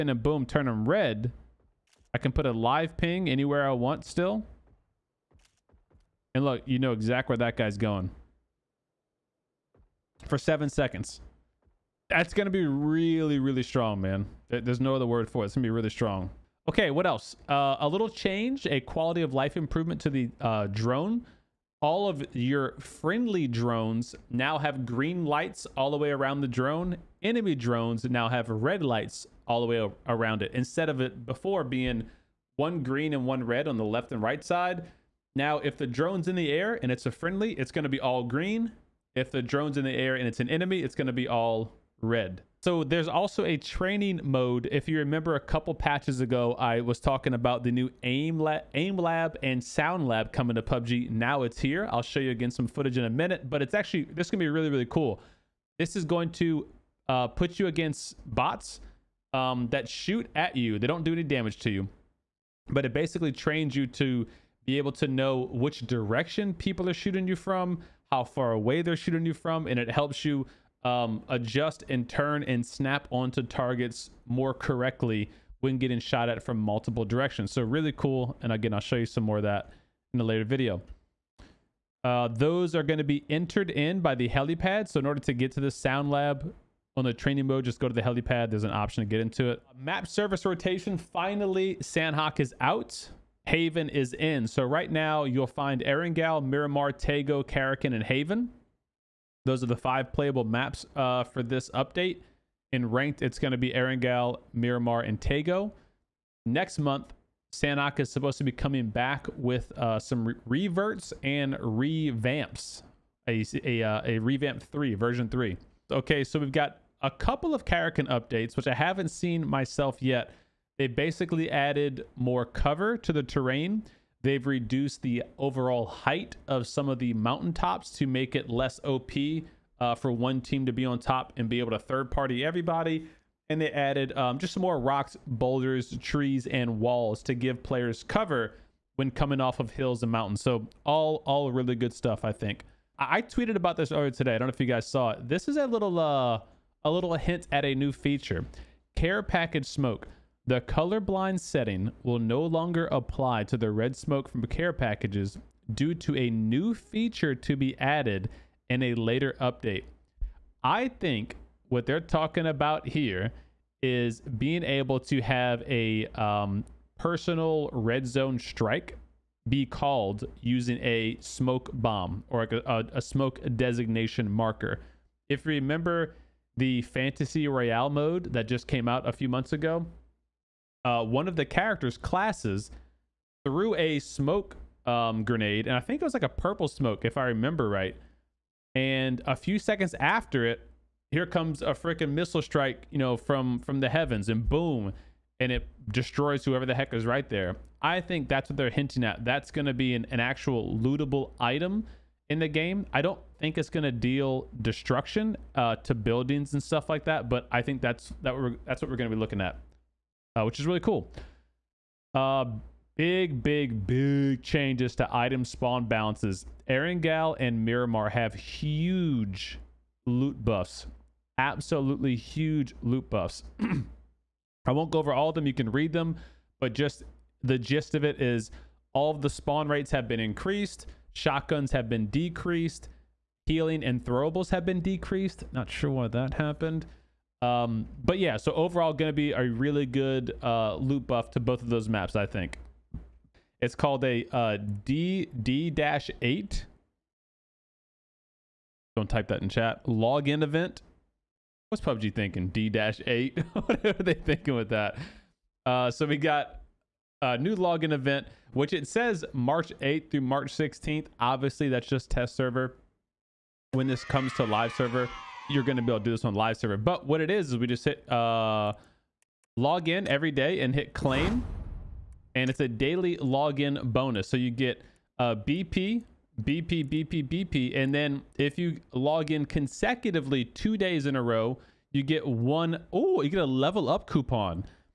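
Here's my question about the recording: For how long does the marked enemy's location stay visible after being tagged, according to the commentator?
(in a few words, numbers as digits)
7 seconds.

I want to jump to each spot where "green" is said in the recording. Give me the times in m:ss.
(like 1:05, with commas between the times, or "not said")
0:24, 0:32, 0:38.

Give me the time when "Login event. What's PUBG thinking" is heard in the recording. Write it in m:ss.
4:09.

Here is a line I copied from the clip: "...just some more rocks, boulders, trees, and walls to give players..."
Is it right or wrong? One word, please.
right.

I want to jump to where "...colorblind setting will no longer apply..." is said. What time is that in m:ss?
2:30.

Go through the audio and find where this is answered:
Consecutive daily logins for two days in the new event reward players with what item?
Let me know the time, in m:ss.
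4:43.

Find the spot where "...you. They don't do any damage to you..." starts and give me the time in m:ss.
1:00.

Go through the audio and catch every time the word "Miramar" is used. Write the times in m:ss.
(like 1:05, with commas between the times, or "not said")
1:36, 1:44, 3:37.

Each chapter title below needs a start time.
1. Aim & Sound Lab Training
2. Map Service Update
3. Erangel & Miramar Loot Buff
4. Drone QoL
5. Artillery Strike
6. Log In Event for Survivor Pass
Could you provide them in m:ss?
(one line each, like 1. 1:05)
1. 0:44
2. 1:29
3. 3:34
4. 0:19
5. 2:24
6. 4:09.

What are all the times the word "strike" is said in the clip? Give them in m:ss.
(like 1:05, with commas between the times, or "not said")
2:48, 3:12.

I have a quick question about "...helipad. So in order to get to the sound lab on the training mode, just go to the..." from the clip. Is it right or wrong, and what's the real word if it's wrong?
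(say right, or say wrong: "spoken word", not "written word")
right.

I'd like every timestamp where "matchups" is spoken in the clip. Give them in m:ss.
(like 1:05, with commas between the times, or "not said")
not said.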